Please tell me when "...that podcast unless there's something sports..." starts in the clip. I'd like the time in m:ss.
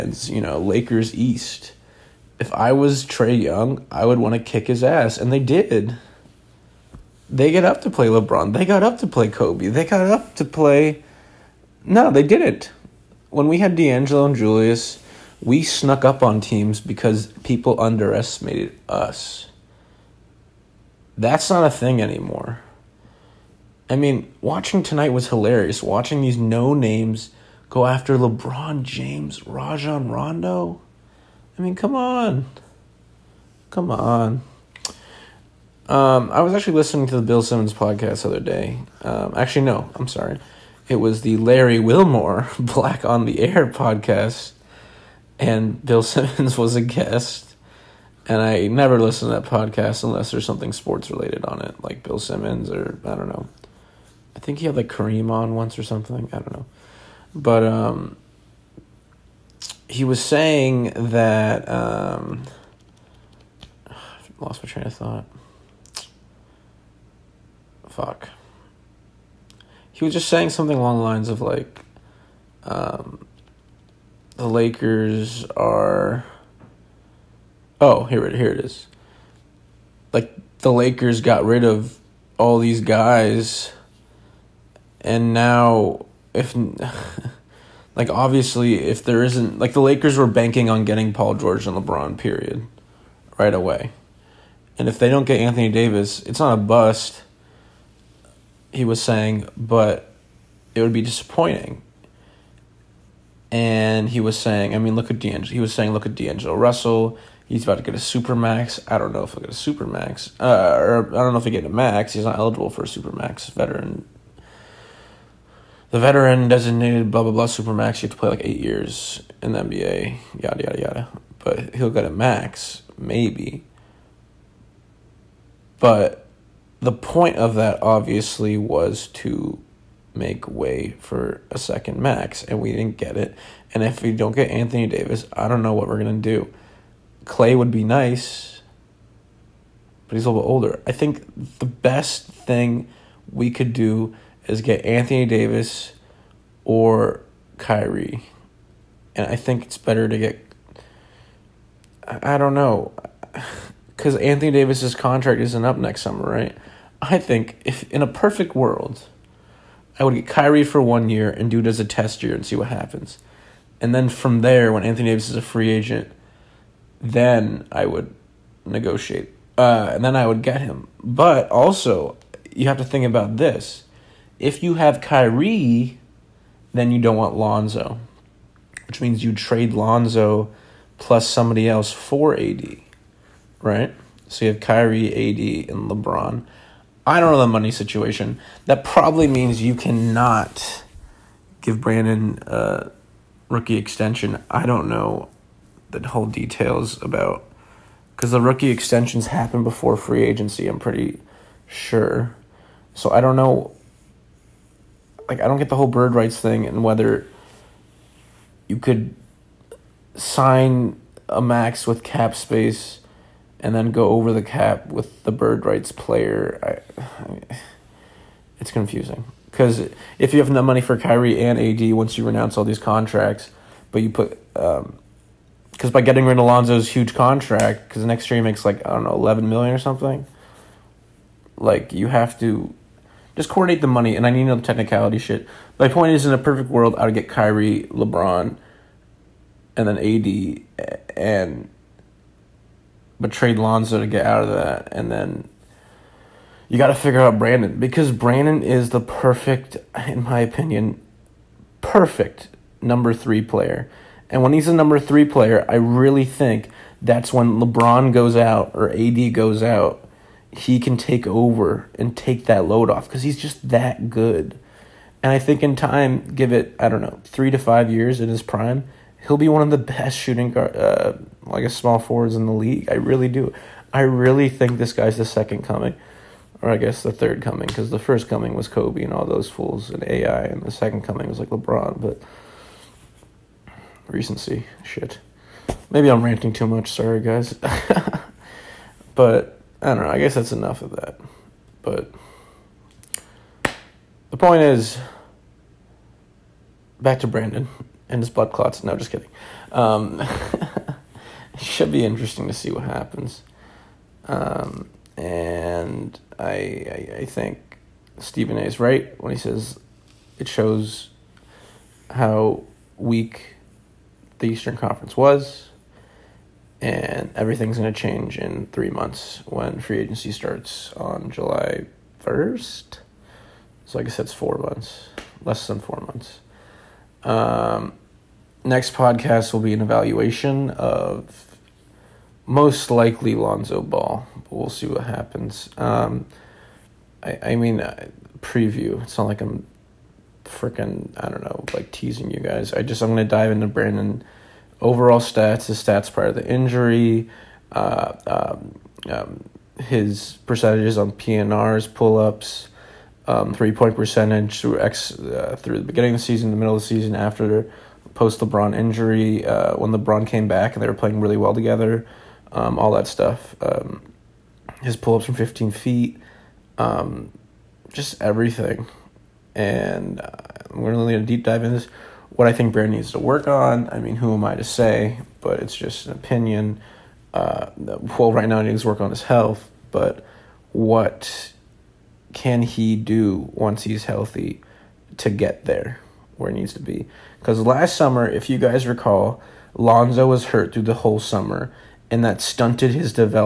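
0:49.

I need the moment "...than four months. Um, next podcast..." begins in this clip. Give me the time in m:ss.
5:25.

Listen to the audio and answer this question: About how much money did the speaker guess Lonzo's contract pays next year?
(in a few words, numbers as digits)
11 million.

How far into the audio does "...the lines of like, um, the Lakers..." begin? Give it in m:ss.
1:10.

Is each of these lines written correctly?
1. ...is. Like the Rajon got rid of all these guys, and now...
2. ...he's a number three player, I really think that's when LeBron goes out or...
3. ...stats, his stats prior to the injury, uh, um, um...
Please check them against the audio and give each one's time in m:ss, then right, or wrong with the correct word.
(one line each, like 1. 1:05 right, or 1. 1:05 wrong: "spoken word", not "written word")
1. 1:18 wrong: "Lakers", not "Rajon"
2. 4:14 right
3. 5:45 right.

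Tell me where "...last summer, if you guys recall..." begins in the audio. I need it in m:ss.
6:27.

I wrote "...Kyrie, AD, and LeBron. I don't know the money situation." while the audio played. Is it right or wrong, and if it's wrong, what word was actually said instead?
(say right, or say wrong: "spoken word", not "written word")
right.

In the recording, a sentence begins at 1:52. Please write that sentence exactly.
He's not eligible for a super max.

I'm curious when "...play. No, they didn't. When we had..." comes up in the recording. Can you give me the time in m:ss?
0:10.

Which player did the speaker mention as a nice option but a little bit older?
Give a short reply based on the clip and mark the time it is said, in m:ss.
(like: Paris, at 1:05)
Clay, at 2:17.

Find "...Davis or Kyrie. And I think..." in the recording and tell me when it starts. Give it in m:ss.
2:25.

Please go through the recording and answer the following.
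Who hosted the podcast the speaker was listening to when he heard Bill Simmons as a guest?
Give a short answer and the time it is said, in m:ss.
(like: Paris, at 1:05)
Larry Wilmore, at 0:41.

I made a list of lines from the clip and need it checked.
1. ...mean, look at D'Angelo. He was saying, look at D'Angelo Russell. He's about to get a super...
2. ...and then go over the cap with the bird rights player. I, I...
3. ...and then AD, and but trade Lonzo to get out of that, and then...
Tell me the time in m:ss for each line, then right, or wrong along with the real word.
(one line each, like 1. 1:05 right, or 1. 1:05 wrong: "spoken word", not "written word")
1. 1:44 right
2. 3:33 right
3. 3:59 right.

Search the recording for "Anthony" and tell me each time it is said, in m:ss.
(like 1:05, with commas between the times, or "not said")
1:35, 2:14, 2:24, 2:34, 2:44.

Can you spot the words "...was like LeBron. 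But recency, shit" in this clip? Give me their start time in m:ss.
4:41.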